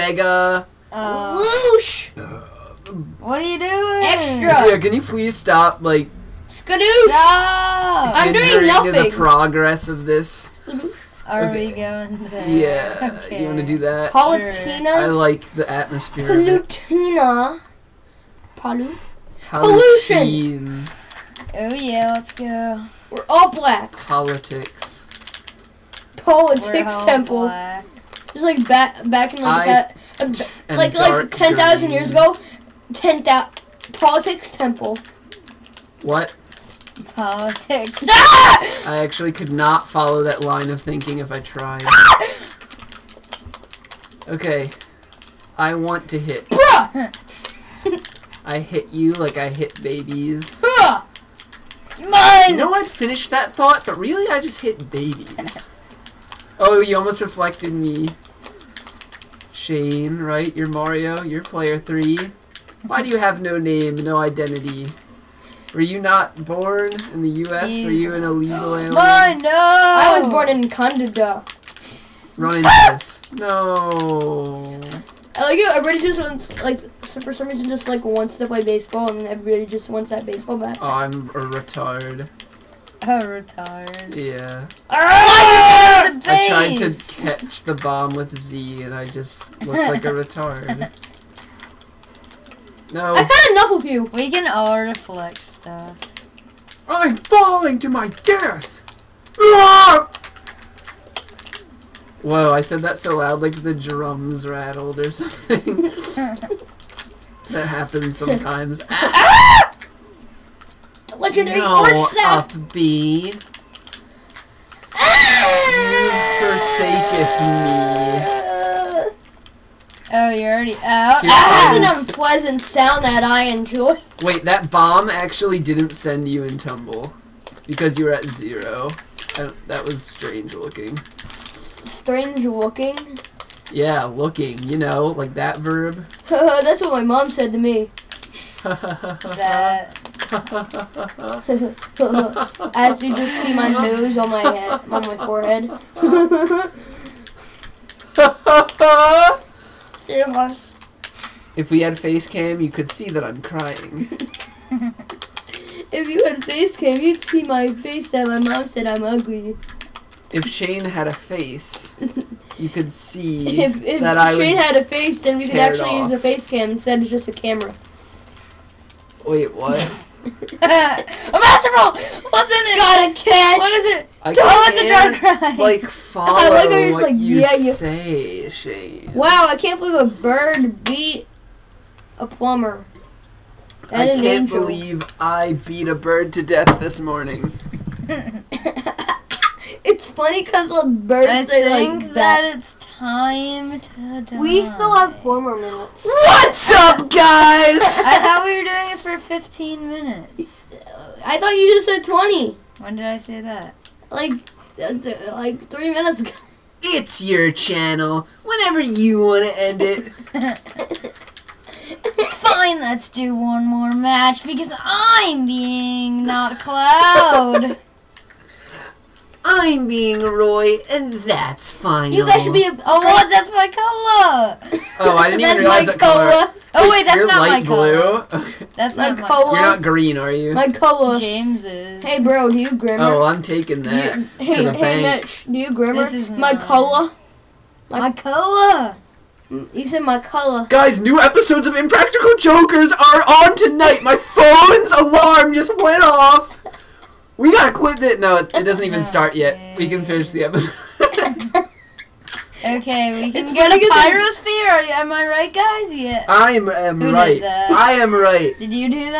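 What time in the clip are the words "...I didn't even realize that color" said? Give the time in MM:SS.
03:45.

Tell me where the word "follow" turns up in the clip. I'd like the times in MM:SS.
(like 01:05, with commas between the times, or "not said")
00:39, 02:55.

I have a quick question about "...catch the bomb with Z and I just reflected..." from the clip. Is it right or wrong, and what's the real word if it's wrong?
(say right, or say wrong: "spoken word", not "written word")
wrong: "looked", not "reflected".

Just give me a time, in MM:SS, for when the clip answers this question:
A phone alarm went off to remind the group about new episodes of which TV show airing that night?
04:01.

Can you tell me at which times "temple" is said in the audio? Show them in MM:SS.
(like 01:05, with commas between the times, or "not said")
00:27, 00:34.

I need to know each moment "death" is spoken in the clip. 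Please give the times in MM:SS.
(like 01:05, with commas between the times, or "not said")
01:38, 03:06.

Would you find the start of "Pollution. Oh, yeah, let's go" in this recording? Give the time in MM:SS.
00:19.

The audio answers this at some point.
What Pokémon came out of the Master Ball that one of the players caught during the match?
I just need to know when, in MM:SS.
02:55.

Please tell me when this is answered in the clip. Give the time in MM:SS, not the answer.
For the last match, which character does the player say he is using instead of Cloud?
03:40.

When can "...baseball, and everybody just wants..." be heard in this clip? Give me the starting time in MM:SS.
01:18.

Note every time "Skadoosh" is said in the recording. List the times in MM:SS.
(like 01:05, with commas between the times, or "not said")
00:06.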